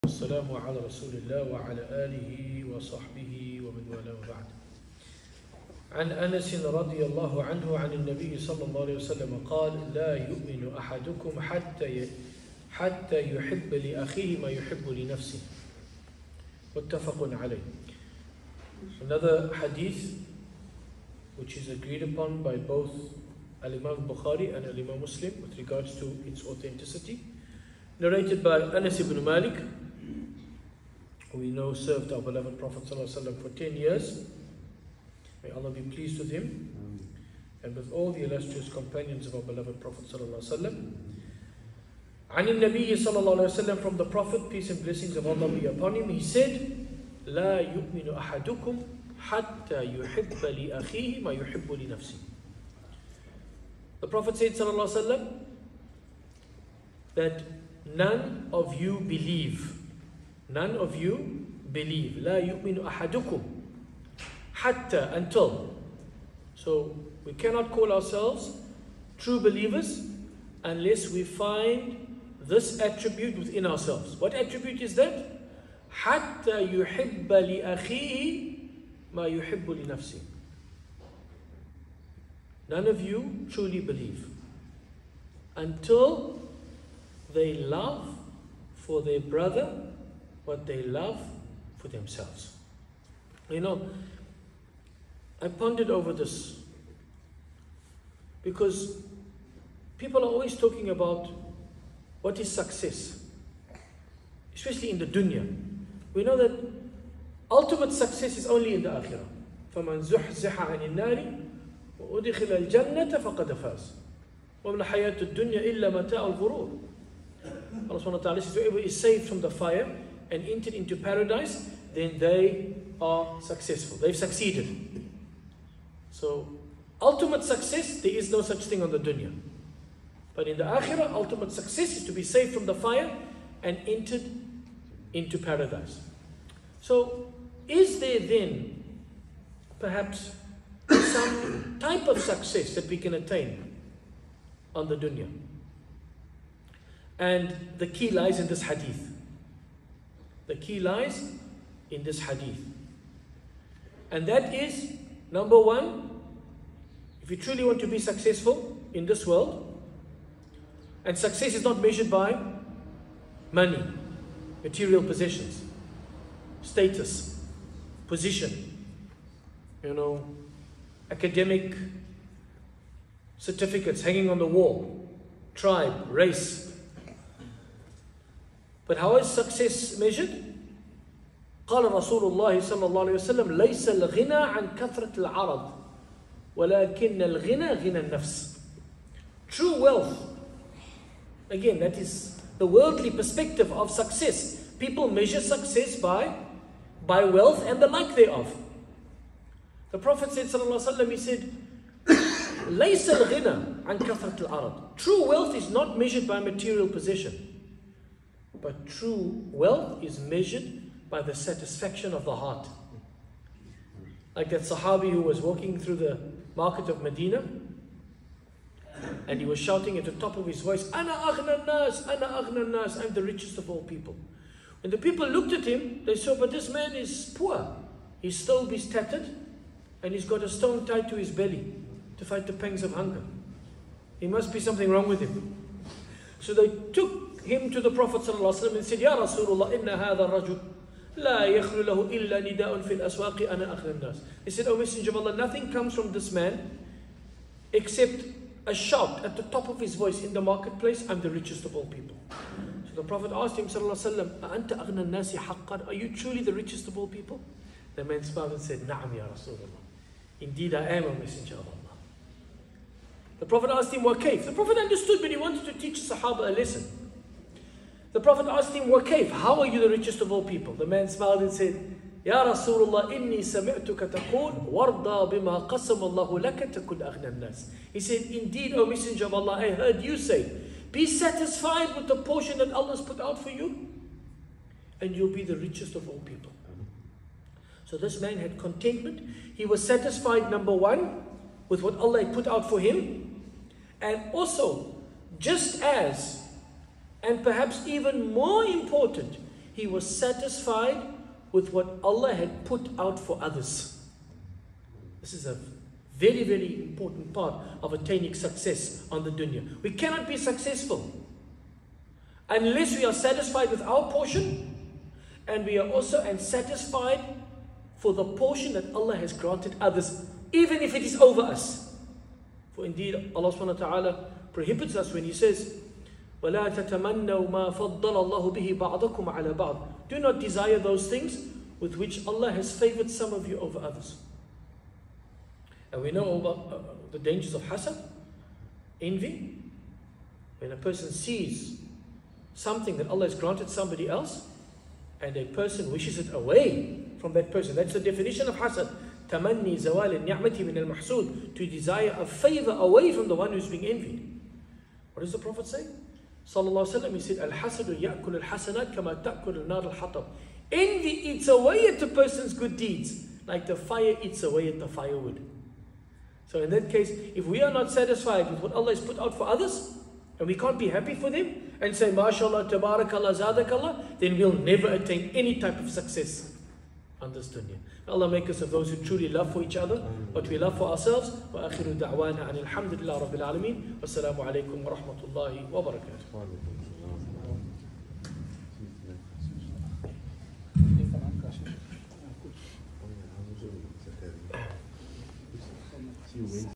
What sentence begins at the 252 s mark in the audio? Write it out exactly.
So the Prophet asked him, وسلم, Are you truly the richest of all people?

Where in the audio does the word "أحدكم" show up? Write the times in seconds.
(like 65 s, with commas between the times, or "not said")
10 s, 48 s.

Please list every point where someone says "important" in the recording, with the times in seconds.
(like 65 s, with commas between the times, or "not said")
298 s, 306 s.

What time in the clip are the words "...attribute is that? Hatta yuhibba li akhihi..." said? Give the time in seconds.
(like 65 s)
74 s.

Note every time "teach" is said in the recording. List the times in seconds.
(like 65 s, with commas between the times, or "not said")
265 s.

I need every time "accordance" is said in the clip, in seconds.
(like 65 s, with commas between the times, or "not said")
not said.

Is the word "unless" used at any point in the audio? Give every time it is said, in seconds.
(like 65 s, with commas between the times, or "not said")
70 s, 312 s.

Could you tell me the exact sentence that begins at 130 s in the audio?
But in the akhirah, ultimate success is to be saved from the fire and entered into paradise.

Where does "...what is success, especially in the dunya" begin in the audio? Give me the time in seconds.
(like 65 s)
102 s.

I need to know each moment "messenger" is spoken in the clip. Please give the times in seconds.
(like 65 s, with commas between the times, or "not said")
244 s, 261 s, 278 s.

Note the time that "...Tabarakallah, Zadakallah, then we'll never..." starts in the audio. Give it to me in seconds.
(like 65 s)
372 s.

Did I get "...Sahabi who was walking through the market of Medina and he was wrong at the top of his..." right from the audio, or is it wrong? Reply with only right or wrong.
wrong.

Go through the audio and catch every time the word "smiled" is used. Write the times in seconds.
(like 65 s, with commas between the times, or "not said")
258 s, 271 s.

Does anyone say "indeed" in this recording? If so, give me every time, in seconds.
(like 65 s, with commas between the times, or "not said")
260 s, 278 s, 322 s.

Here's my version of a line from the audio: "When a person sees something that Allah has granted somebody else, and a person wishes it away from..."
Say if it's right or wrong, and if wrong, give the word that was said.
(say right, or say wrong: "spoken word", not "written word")
right.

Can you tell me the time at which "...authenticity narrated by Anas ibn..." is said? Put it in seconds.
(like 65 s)
26 s.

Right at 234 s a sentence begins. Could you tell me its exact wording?
He must be something wrong with him.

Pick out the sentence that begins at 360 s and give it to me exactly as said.
Envy eats away at a person's good deeds, like the fire eats away at the firewood.